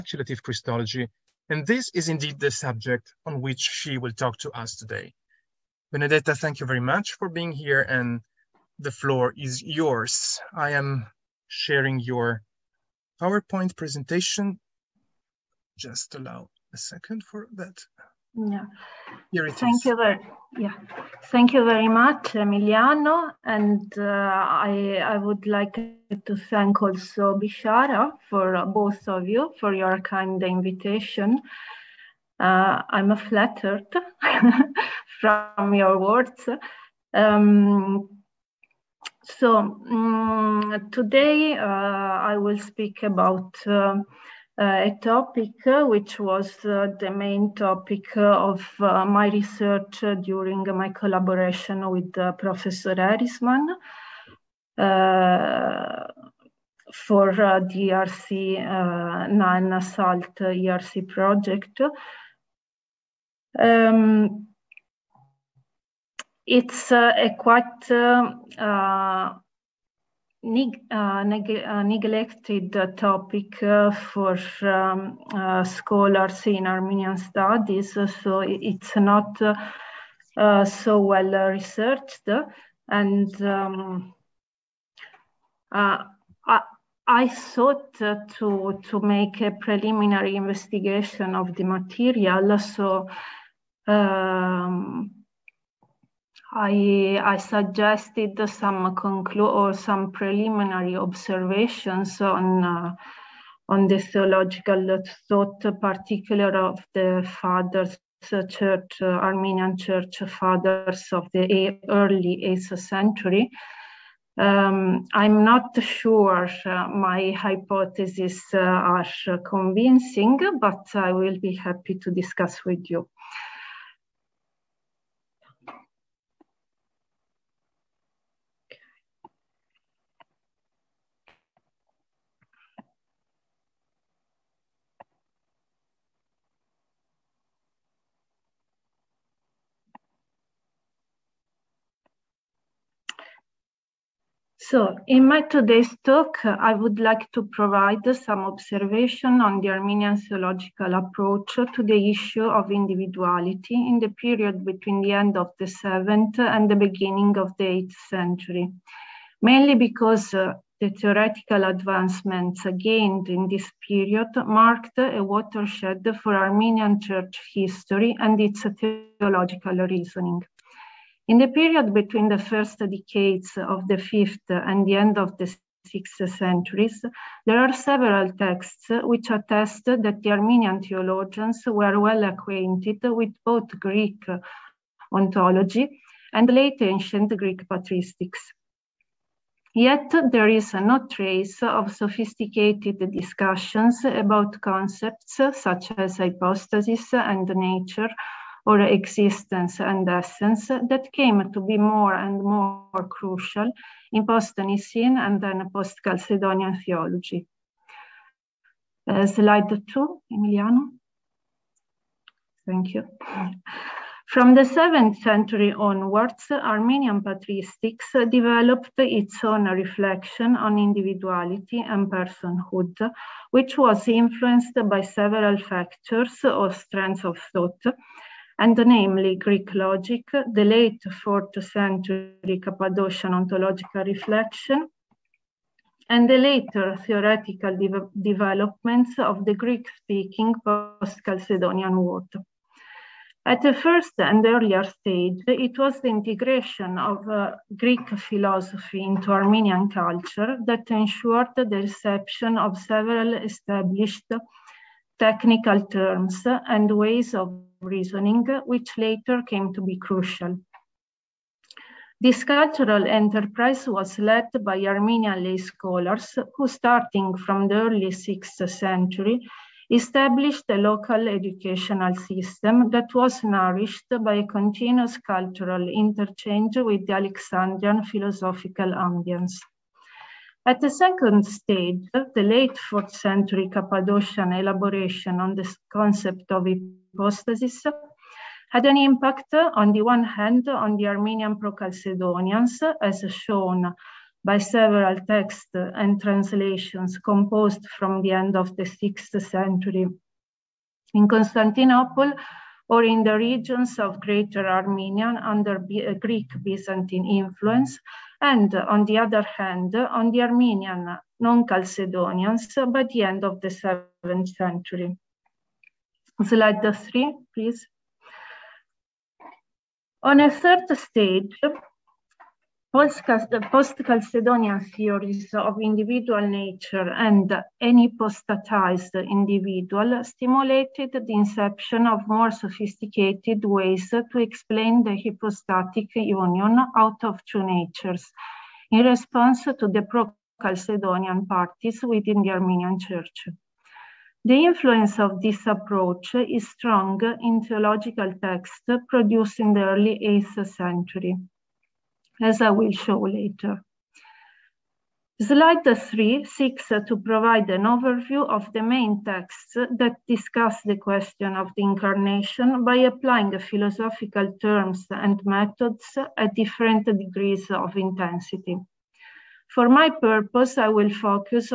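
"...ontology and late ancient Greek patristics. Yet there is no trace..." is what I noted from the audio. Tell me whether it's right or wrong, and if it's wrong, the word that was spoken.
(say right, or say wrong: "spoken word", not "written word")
right.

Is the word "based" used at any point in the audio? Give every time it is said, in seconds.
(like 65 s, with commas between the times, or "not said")
not said.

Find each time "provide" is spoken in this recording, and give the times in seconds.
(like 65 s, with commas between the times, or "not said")
147 s, 357 s.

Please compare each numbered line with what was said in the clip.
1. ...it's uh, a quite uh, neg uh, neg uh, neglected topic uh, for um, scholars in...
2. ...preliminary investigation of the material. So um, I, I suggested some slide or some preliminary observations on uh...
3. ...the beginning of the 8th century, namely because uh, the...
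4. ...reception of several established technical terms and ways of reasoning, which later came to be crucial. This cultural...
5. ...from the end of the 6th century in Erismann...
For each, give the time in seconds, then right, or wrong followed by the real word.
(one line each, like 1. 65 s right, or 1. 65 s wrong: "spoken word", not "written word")
1. 66 s right
2. 89 s wrong: "conclude", not "slide"
3. 156 s wrong: "mainly", not "namely"
4. 251 s right
5. 297 s wrong: "Constantinople", not "Erismann".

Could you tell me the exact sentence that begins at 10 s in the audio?
I am sharing your PowerPoint presentation.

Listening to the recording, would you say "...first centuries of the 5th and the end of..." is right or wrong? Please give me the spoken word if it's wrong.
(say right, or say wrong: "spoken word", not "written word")
wrong: "decades", not "centuries".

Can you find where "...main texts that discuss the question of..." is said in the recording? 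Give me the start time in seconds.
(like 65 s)
358 s.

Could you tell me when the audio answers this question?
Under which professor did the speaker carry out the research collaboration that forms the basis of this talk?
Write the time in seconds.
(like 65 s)
52 s.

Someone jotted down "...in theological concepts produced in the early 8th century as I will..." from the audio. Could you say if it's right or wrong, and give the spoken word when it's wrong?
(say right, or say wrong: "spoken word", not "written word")
wrong: "texts", not "concepts".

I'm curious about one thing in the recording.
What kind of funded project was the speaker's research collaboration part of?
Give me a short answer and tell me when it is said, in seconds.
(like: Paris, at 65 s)
ERC project, at 60 s.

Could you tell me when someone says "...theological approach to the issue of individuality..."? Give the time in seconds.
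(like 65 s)
150 s.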